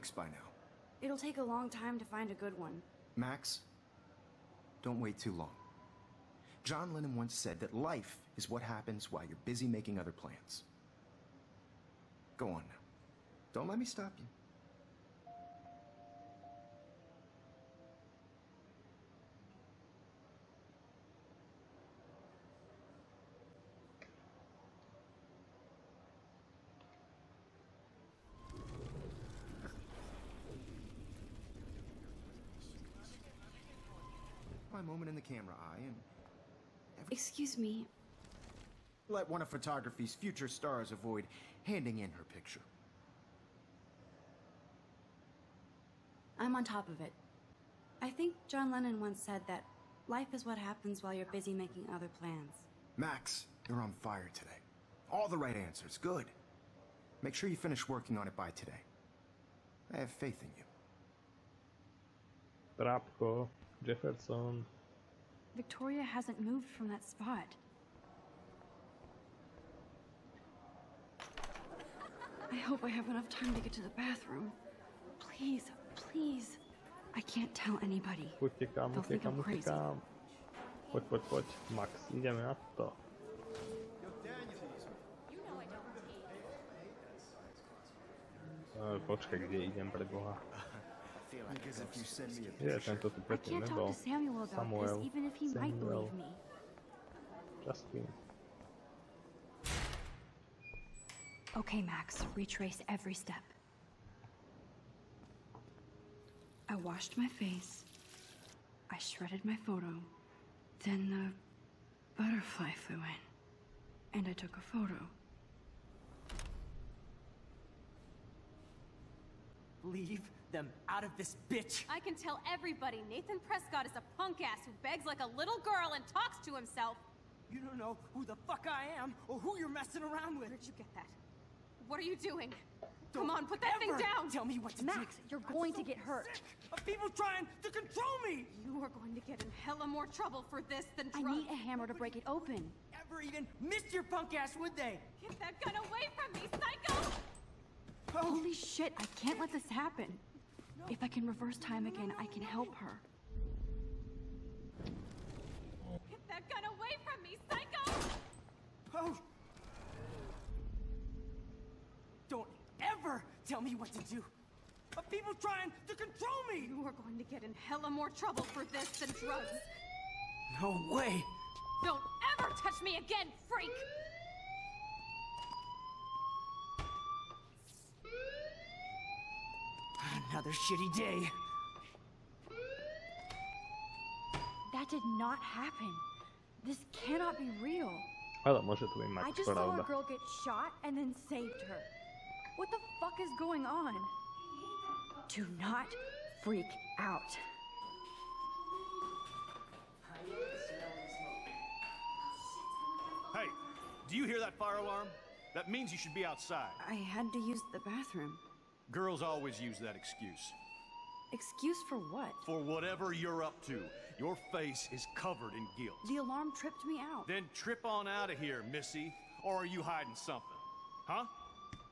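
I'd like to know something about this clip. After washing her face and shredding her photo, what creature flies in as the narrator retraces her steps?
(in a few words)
butterfly.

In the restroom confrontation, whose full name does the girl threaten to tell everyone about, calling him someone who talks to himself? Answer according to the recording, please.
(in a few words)
Nathan Prescott.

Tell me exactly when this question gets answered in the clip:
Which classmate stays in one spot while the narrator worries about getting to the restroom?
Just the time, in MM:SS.
01:05.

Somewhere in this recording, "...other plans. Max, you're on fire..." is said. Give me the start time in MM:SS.
00:51.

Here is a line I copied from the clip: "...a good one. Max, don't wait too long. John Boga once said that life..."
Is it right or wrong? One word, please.
wrong.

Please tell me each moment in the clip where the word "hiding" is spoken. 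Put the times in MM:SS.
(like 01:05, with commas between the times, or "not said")
03:39.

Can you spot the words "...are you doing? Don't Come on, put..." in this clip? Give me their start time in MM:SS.
02:11.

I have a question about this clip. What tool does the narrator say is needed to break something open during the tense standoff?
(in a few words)
hammer.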